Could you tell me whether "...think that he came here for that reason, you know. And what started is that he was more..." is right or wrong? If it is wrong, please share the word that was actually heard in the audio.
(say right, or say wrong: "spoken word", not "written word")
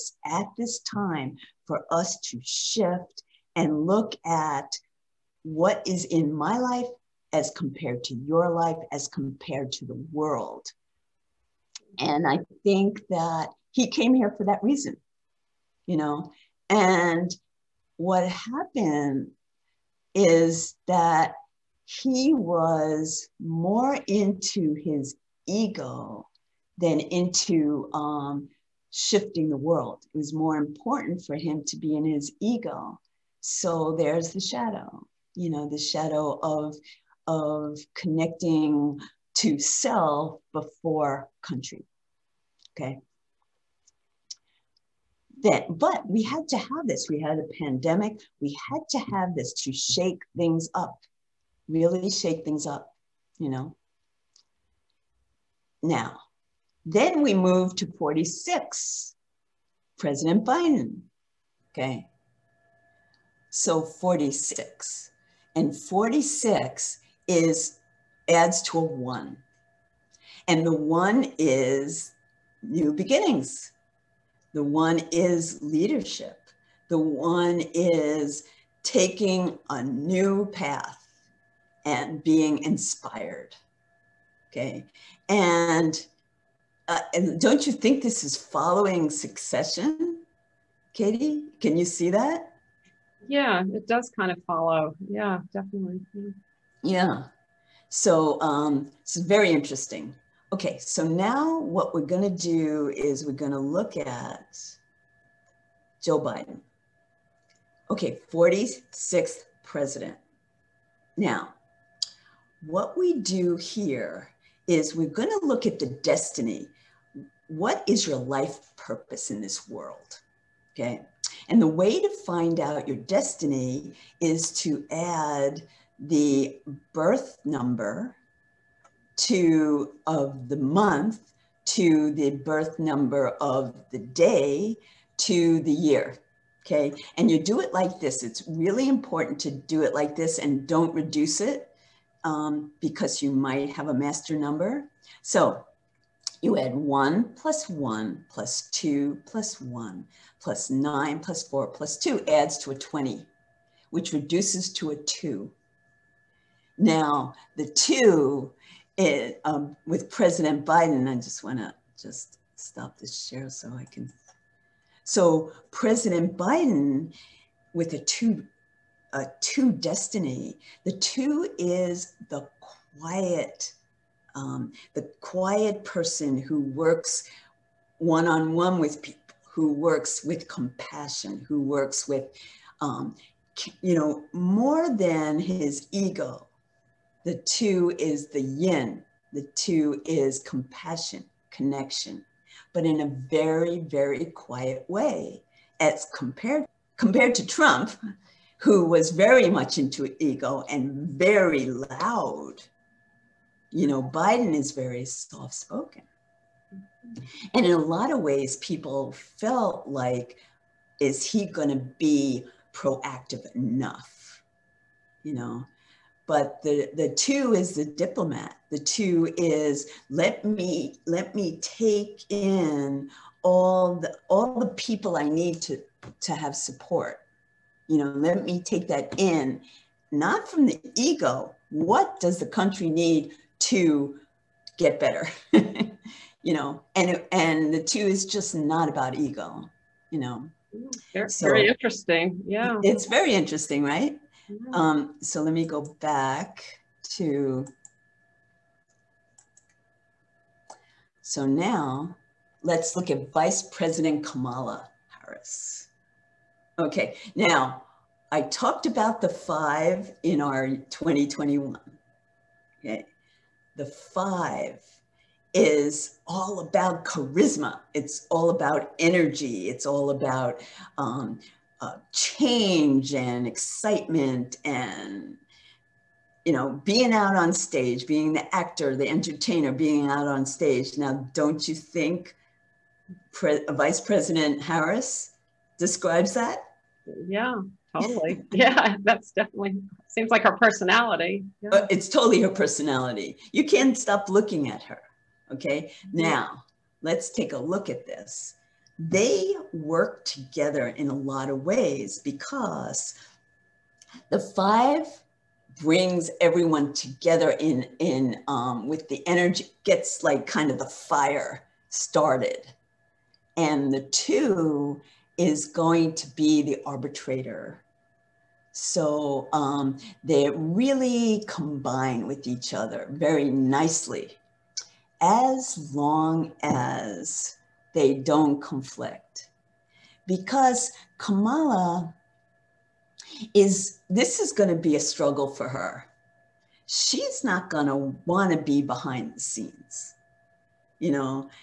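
wrong: "happened", not "started".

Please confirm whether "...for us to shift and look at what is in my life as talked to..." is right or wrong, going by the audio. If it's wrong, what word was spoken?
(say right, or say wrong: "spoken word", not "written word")
wrong: "compared", not "talked".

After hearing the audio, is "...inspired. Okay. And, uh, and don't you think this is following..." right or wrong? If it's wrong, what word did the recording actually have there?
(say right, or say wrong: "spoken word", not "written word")
right.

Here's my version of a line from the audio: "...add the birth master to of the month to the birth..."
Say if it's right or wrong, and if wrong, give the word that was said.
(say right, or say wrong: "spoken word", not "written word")
wrong: "number", not "master".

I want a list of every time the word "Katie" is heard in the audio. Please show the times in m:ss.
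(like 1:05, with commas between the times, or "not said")
1:30.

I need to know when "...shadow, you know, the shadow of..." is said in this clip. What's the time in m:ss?
0:34.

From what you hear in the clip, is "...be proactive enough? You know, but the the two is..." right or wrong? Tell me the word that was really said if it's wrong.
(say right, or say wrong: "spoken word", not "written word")
right.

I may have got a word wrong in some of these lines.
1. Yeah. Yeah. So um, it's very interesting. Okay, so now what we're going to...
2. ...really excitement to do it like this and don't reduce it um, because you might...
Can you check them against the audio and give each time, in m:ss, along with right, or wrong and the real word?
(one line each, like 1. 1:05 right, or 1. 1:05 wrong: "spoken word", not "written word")
1. 1:36 right
2. 2:18 wrong: "important", not "excitement".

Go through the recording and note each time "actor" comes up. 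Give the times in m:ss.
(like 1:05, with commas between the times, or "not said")
4:38.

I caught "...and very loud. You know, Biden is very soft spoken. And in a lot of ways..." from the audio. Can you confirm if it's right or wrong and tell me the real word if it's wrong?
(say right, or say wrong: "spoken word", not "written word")
right.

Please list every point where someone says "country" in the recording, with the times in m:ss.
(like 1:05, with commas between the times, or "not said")
0:41, 3:52.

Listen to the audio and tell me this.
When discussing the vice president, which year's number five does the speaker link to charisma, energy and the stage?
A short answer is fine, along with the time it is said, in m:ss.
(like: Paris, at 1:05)
2021, at 4:20.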